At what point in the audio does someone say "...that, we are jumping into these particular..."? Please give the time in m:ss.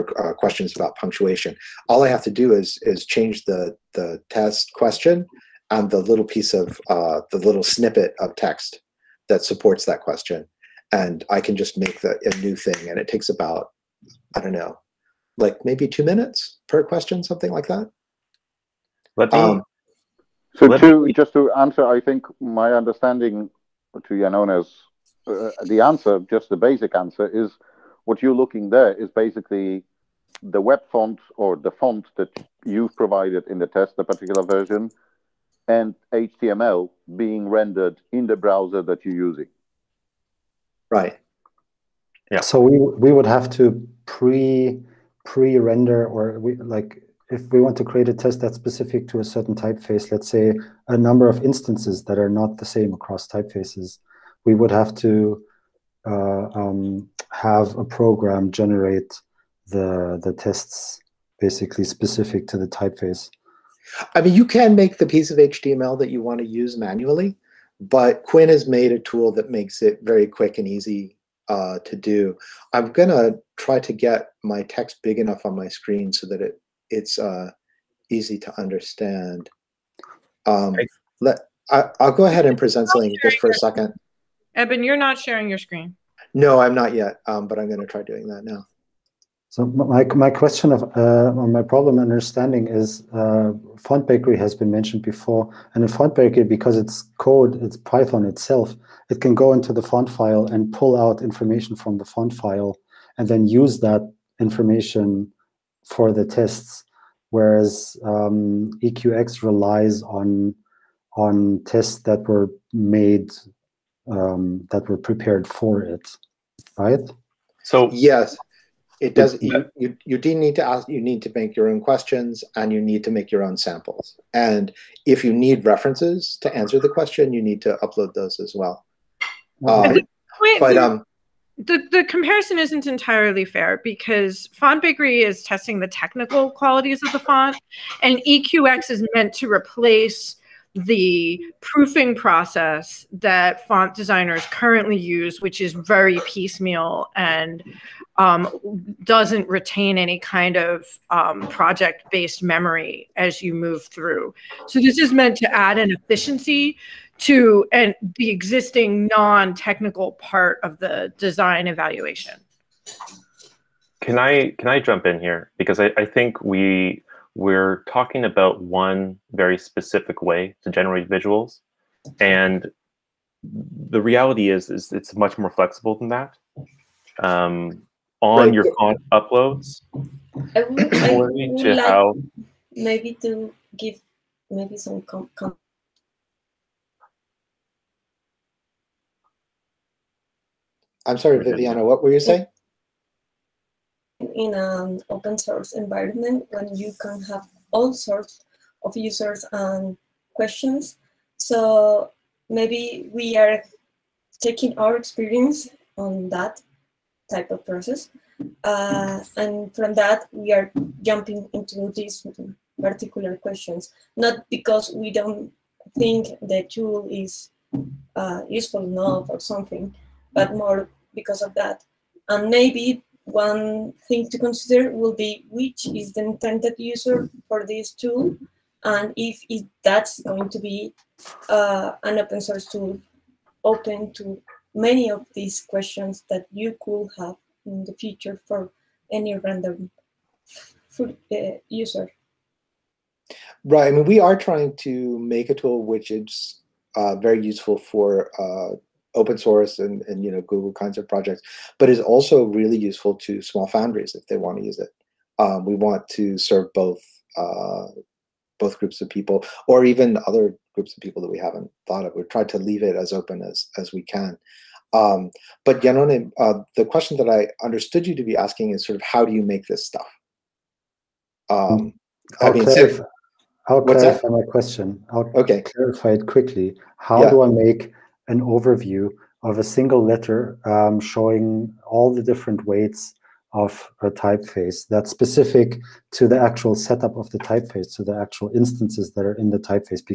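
3:29.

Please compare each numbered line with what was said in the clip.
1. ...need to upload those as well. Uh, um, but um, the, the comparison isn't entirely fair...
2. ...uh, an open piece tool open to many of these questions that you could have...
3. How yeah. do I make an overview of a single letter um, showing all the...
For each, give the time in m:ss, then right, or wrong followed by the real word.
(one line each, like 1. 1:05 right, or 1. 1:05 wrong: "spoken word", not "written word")
1. 2:07 right
2. 3:51 wrong: "source", not "piece"
3. 4:36 right.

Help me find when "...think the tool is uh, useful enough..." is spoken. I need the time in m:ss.
3:35.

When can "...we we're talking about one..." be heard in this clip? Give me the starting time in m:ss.
2:46.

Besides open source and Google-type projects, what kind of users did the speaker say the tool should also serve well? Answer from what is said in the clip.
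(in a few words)
small foundries.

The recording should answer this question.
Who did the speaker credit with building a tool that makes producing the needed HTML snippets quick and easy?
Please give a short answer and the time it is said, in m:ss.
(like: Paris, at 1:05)
Quinn, at 1:08.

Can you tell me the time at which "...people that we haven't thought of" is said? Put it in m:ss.
4:21.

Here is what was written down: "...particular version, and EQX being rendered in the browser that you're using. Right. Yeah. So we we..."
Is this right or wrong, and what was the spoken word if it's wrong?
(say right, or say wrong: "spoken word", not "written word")
wrong: "HTML", not "EQX".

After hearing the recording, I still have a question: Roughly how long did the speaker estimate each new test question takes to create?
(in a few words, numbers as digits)
2 minutes.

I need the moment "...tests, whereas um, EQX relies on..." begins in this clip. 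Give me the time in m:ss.
1:46.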